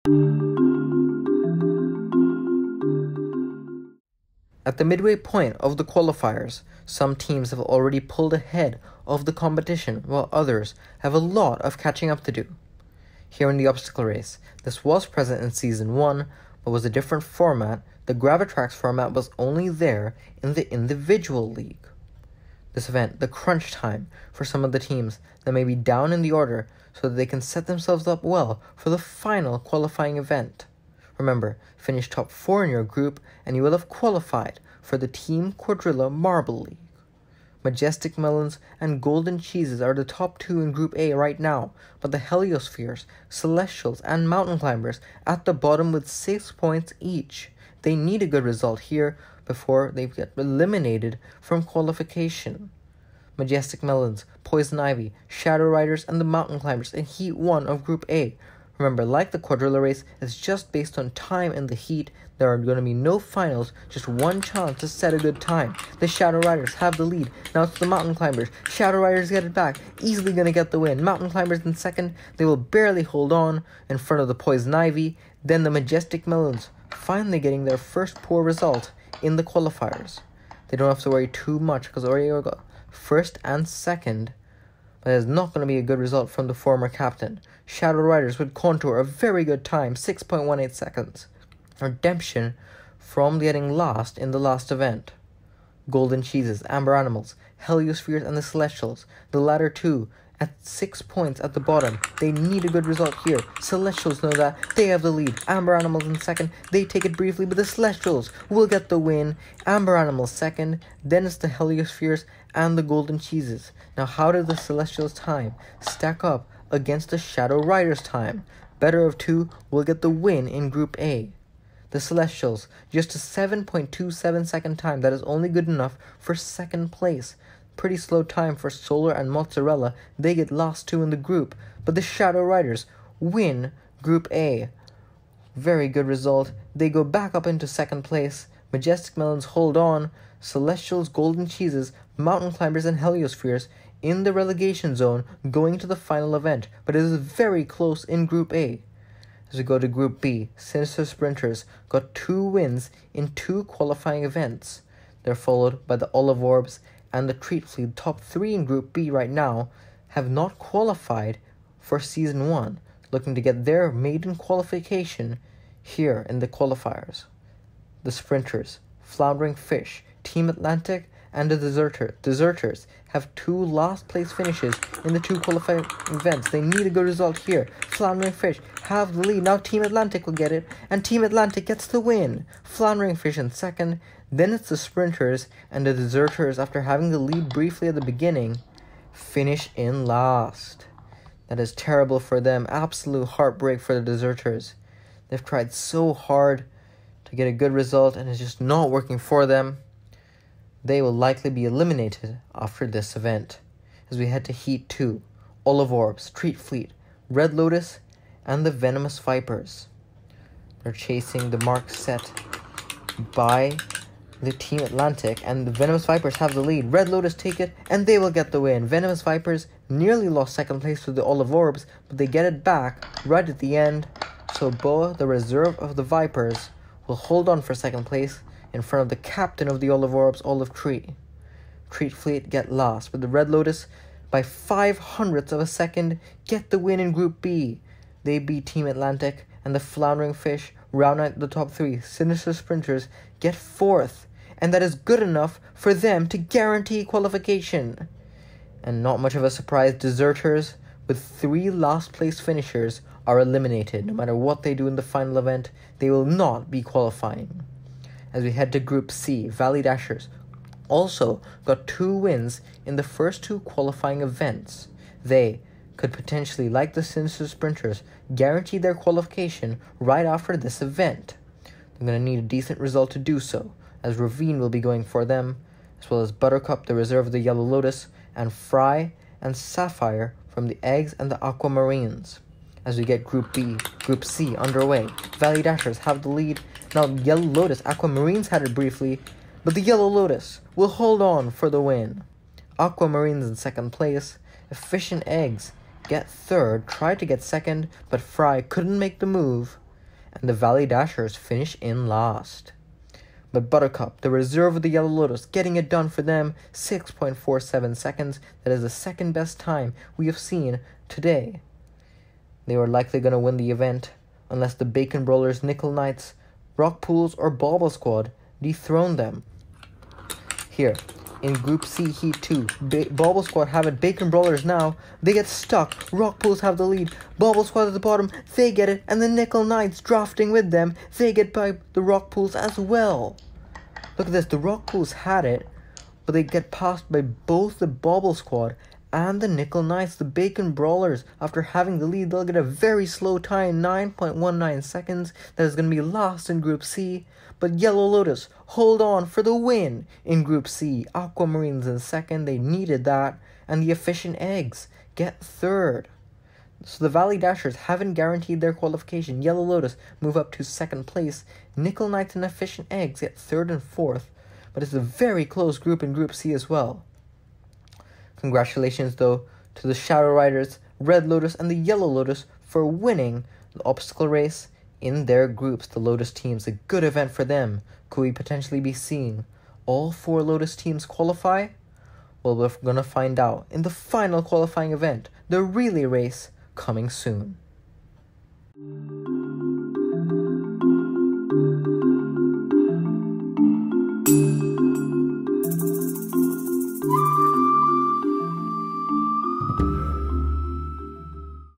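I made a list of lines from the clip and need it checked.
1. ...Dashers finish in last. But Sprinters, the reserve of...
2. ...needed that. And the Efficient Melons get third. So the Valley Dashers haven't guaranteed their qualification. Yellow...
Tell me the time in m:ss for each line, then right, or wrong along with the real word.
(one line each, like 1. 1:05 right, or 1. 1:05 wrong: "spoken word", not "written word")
1. 5:00 wrong: "Buttercup", not "Sprinters"
2. 5:52 wrong: "Eggs", not "Melons".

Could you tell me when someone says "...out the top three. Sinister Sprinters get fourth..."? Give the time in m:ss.
4:01.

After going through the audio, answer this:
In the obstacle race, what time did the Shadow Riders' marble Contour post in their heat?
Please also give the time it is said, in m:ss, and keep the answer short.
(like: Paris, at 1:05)
6.18 seconds, at 1:29.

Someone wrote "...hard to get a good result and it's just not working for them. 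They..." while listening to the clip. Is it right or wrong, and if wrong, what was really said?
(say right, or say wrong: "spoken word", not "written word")
right.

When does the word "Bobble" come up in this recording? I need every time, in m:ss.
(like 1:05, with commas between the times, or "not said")
5:17, 5:23, 5:27, 5:37.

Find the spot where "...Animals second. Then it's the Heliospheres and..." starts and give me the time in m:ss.
1:49.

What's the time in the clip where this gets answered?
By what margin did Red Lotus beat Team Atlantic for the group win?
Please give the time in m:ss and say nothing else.
3:54.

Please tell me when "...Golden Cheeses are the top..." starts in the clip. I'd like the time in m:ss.
0:39.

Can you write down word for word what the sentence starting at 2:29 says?
As we go to Group B, Sinister Sprinters got two wins in two qualifying events.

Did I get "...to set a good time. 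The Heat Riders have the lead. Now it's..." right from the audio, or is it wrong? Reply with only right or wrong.
wrong.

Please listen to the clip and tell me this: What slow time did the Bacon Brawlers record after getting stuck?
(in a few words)
9.19 seconds.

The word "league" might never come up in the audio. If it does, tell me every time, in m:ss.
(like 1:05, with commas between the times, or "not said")
0:21, 0:36.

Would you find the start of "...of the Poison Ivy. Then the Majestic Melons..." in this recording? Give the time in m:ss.
1:14.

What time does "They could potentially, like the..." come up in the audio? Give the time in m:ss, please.
4:25.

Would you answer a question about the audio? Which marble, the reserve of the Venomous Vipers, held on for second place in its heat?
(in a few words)
Boa.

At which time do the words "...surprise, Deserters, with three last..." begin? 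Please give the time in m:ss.
4:09.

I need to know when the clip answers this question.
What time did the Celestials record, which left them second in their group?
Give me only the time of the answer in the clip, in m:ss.
2:03.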